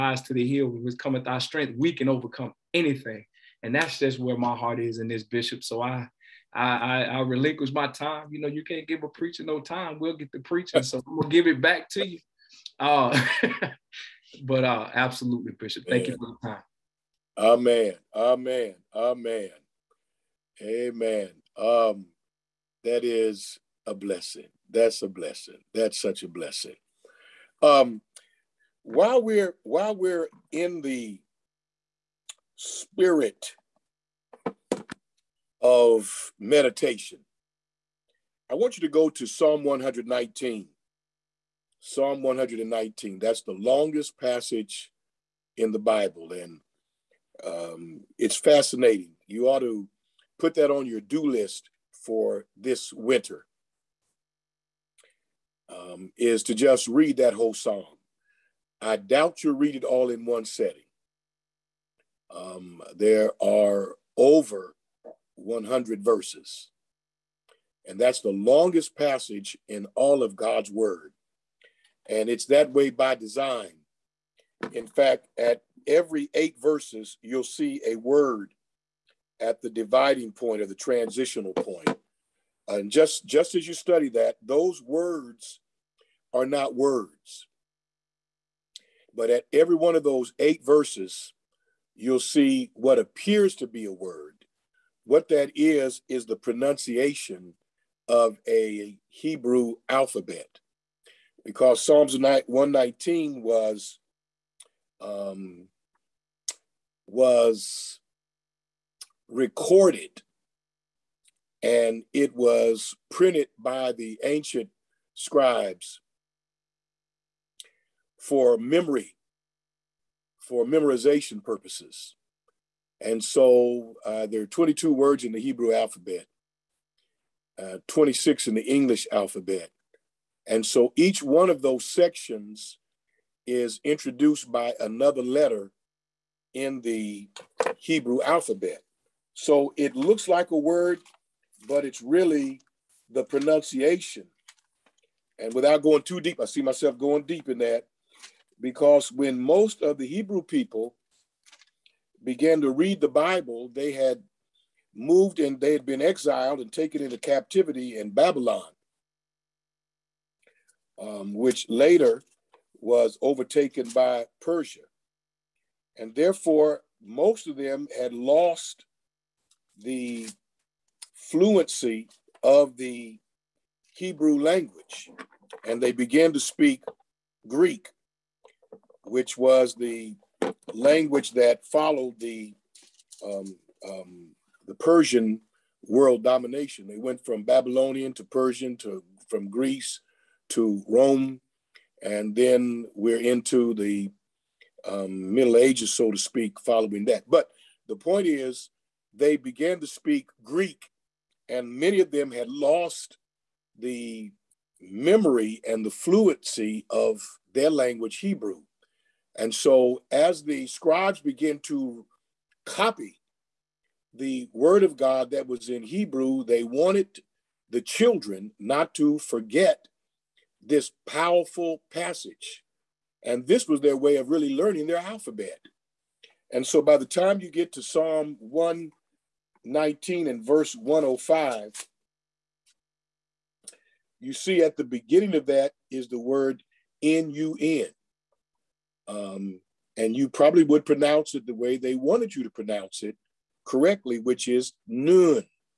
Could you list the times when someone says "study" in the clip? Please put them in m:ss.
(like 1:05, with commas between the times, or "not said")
1:23.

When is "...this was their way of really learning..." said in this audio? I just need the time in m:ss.
3:43.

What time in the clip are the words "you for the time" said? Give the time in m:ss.
0:16.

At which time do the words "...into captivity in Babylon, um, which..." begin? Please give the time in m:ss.
2:37.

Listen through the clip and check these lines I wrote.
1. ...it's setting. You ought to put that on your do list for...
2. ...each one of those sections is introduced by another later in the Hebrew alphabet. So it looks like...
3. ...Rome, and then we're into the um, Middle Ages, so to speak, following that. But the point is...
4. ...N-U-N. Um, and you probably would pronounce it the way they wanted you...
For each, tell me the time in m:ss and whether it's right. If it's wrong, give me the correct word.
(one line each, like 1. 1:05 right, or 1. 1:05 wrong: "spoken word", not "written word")
1. 0:48 wrong: "fascinating", not "setting"
2. 2:10 wrong: "letter", not "later"
3. 3:10 right
4. 3:57 right.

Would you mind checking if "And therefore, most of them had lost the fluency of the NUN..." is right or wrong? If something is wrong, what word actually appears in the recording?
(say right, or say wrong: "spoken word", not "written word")
wrong: "Hebrew", not "NUN".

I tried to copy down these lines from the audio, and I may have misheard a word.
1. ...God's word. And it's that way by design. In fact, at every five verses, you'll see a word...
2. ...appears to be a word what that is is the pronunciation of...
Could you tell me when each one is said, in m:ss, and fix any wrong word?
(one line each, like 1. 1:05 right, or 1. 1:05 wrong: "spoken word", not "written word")
1. 1:10 wrong: "eight", not "five"
2. 1:32 right.